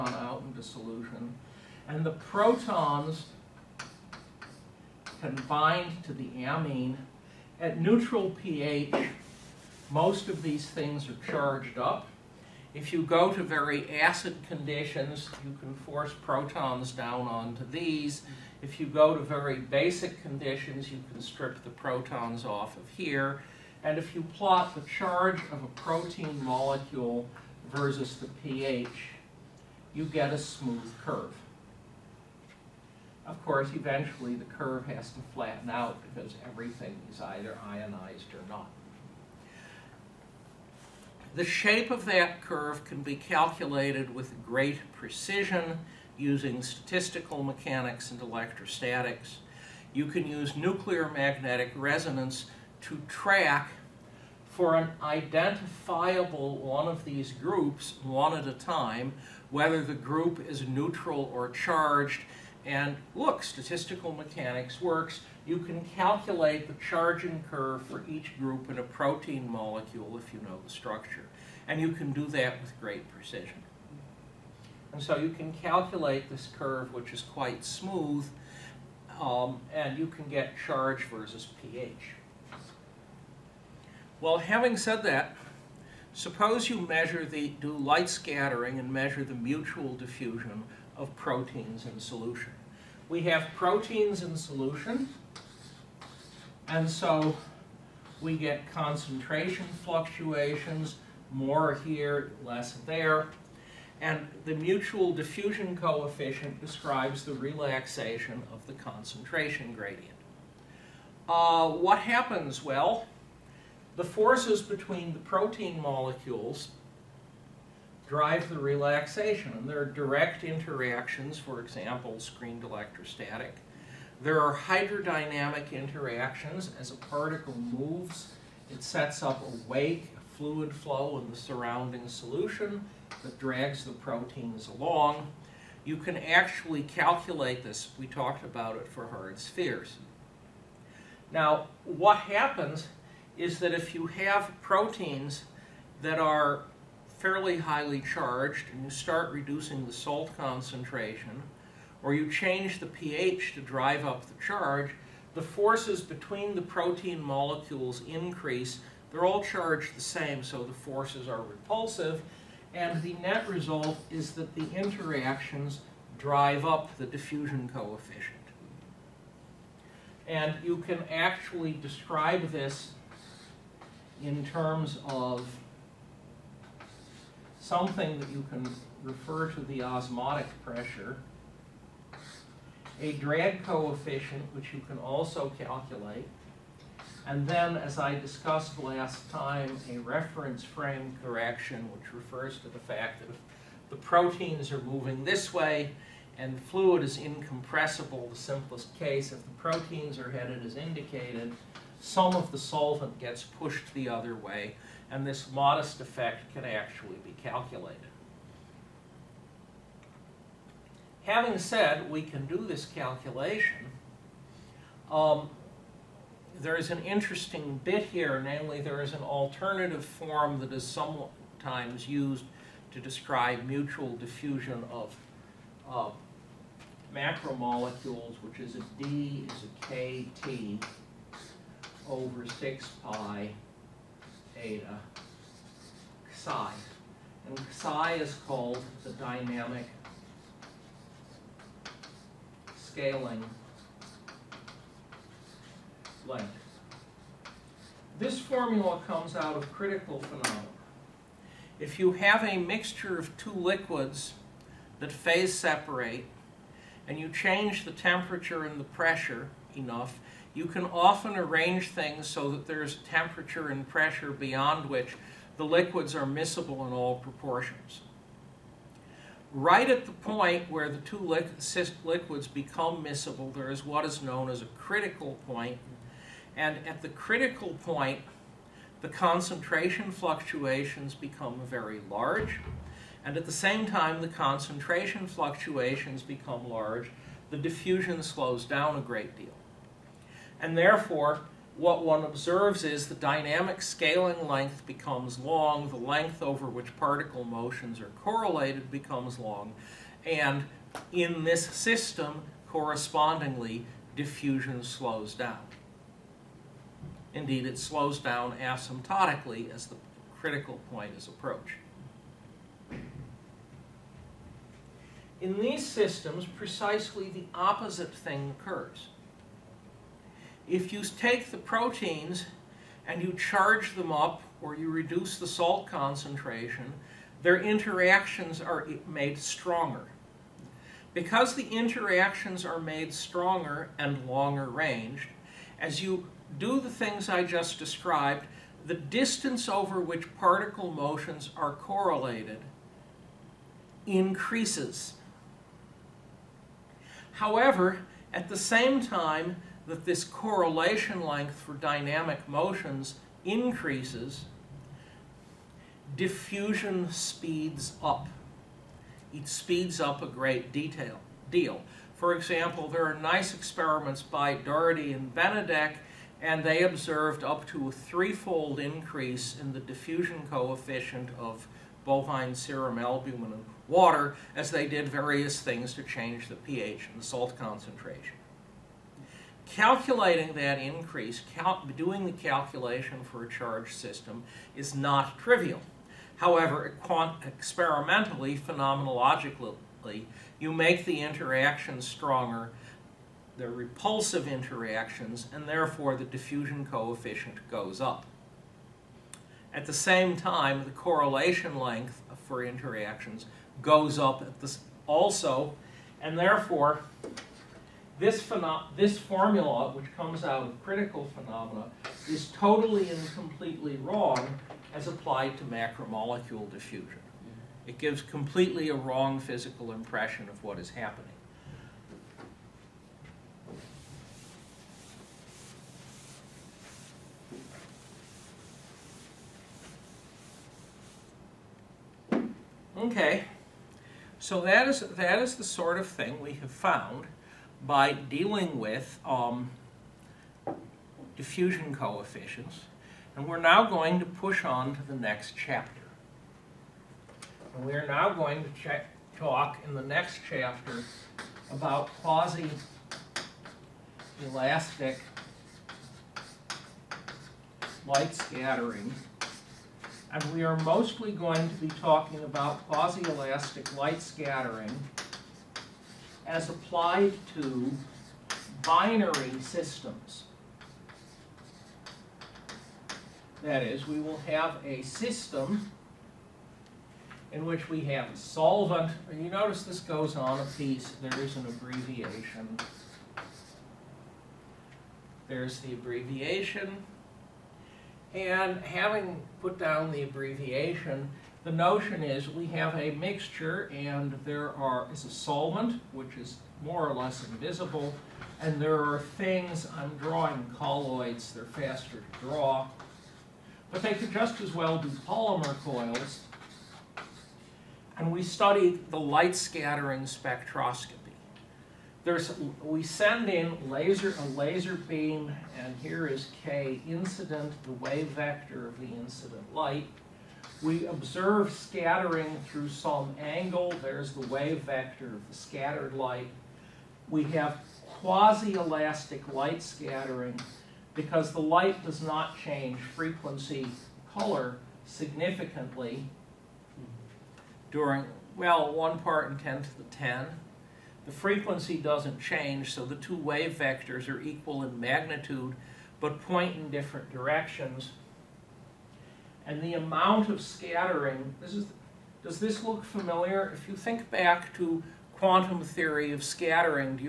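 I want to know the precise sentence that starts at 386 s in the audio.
However, experimentally, phenomenologically, you make the interactions stronger, the repulsive interactions, and therefore the diffusion coefficient goes up.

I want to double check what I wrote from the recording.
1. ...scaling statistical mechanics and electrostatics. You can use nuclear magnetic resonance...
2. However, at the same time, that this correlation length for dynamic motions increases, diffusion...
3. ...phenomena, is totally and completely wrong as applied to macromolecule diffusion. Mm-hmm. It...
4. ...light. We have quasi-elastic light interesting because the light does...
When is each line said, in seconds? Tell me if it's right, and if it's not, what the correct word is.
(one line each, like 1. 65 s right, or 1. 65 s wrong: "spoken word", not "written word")
1. 46 s wrong: "using", not "scaling"
2. 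347 s right
3. 411 s right
4. 526 s wrong: "scattering", not "interesting".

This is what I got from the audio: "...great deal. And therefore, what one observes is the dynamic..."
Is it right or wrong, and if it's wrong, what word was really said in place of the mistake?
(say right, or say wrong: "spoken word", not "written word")
right.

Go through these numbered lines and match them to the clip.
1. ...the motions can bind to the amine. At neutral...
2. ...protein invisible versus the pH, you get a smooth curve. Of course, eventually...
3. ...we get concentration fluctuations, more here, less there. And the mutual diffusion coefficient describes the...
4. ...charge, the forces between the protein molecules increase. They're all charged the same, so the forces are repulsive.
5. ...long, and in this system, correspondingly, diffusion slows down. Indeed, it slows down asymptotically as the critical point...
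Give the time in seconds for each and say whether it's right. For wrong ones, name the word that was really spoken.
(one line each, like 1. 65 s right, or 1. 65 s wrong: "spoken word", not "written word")
1. 2 s wrong: "protons", not "motions"
2. 25 s wrong: "molecule", not "invisible"
3. 98 s right
4. 154 s right
5. 299 s right.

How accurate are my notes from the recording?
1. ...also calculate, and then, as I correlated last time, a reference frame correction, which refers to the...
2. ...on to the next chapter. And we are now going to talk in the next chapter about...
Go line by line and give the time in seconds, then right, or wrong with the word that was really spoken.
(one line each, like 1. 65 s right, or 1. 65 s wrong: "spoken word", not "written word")
1. 184 s wrong: "discussed", not "correlated"
2. 444 s right.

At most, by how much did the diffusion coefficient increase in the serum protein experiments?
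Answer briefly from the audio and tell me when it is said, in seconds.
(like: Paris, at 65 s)
threefold, at 367 s.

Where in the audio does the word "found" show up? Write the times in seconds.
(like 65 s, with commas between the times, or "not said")
436 s.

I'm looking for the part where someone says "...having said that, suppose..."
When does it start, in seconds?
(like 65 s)
84 s.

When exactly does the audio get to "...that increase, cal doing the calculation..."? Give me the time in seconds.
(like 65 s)
380 s.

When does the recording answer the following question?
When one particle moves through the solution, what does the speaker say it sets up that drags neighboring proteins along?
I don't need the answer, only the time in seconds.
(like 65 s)
129 s.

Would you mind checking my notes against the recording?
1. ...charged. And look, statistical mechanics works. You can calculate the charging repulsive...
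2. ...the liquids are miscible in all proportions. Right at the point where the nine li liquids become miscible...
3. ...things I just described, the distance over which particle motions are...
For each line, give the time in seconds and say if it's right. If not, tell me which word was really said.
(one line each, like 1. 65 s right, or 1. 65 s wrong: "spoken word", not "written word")
1. 61 s wrong: "curve", not "repulsive"
2. 265 s wrong: "two", not "nine"
3. 336 s right.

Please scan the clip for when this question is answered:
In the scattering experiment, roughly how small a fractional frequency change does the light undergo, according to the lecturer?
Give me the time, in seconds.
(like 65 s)
538 s.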